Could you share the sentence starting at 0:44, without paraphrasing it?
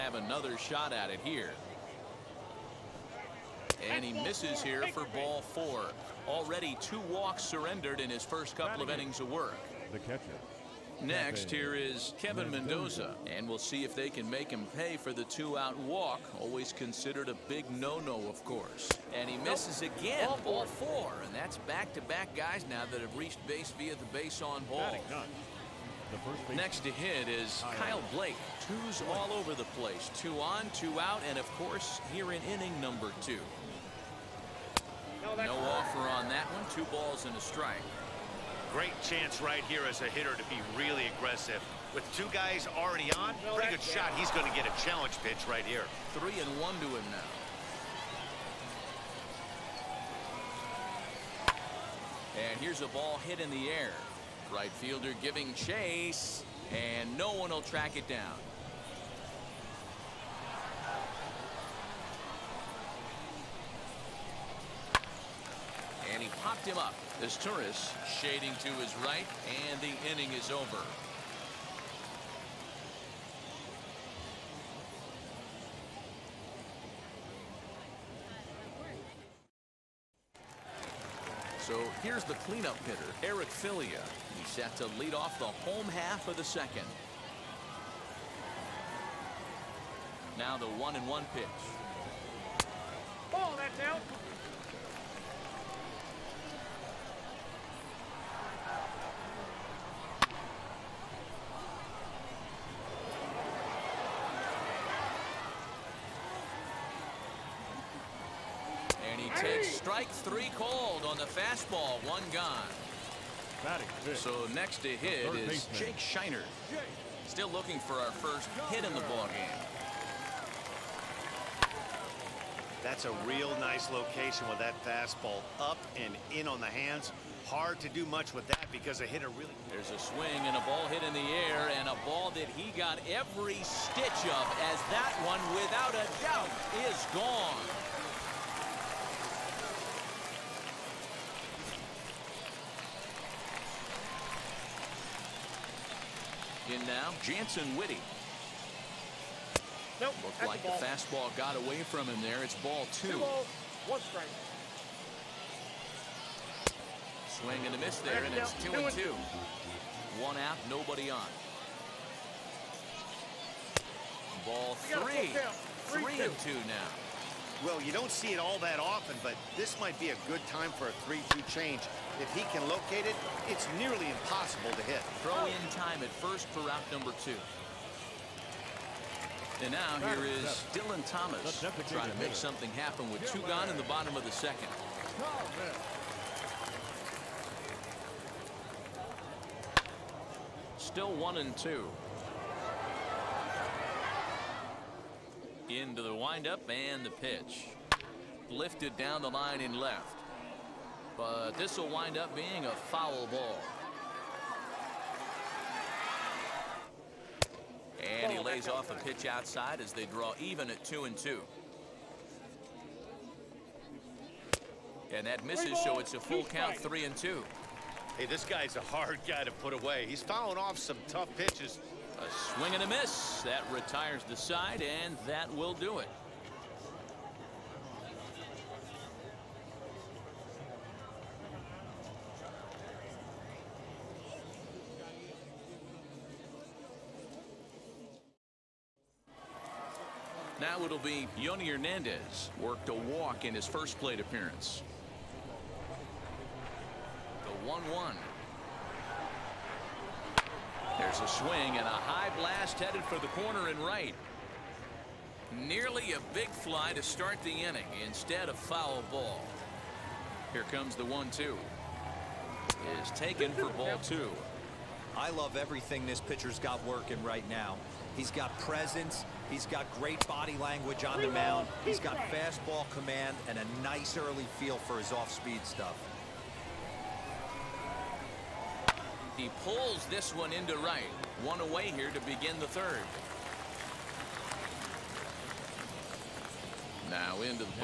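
He's going to get a challenge pitch right here.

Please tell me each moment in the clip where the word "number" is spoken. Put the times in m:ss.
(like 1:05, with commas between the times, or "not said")
0:32, 2:56.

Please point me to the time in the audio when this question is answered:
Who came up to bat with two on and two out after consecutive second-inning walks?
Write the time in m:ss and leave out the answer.
0:27.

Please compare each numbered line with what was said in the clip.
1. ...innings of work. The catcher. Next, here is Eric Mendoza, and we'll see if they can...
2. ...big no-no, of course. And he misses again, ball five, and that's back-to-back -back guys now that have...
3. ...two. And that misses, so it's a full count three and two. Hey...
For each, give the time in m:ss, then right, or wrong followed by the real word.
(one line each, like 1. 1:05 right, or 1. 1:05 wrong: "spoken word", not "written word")
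1. 0:08 wrong: "Kevin", not "Eric"
2. 0:17 wrong: "four", not "five"
3. 3:31 right.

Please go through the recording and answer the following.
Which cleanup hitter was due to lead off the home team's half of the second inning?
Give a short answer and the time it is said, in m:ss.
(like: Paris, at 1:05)
Eric Filia, at 1:23.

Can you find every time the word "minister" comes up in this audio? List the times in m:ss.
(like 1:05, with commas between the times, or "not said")
not said.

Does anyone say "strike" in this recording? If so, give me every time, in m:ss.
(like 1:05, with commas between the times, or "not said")
0:37, 1:49, 2:33.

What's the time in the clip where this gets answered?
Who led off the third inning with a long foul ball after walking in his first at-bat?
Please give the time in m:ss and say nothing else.
4:01.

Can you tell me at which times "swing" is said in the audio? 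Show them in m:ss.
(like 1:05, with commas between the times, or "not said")
2:09, 2:37, 3:42, 4:11.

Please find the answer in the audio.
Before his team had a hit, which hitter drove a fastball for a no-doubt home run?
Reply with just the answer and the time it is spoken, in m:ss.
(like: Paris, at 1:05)
Jake Scheiner, at 1:55.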